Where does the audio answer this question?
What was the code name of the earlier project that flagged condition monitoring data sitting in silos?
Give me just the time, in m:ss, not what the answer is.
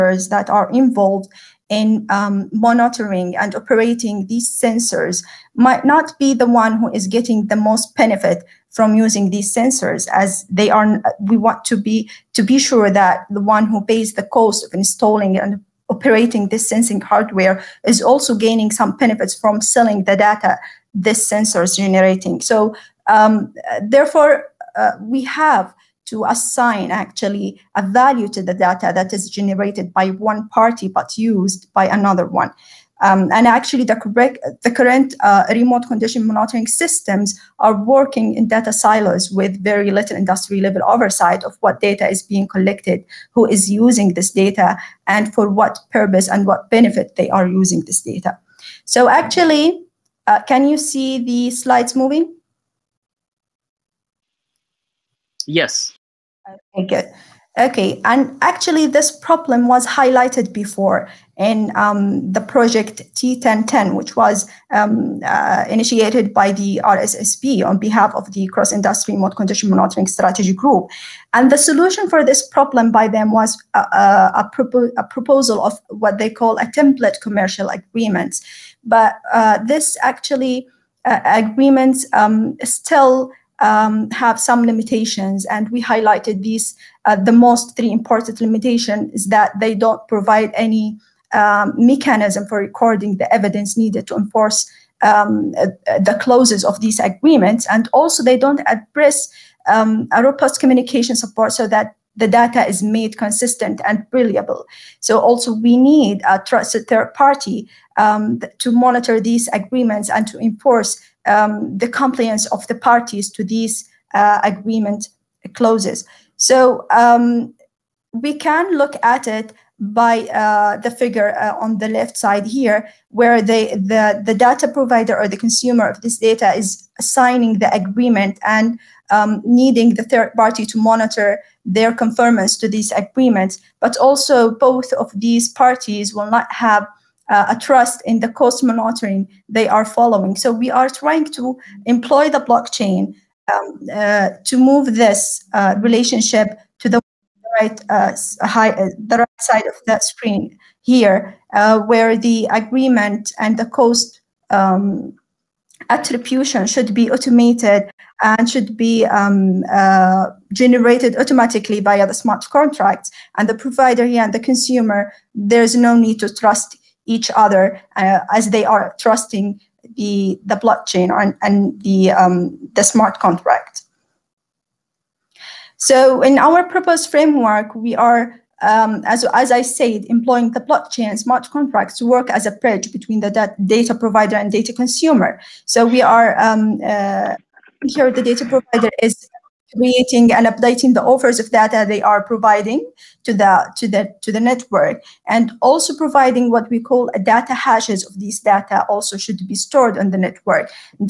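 1:03.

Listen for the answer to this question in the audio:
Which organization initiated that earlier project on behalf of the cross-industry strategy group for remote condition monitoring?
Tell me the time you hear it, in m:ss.
1:06.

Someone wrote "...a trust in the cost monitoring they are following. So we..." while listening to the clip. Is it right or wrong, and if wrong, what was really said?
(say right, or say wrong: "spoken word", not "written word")
right.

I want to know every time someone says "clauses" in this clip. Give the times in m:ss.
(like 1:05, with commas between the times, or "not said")
1:36, 1:55.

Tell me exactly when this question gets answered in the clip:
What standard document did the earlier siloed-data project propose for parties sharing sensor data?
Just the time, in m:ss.
1:16.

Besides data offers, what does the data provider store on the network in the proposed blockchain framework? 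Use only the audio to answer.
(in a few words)
data hashes.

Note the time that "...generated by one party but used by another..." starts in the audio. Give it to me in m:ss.
0:29.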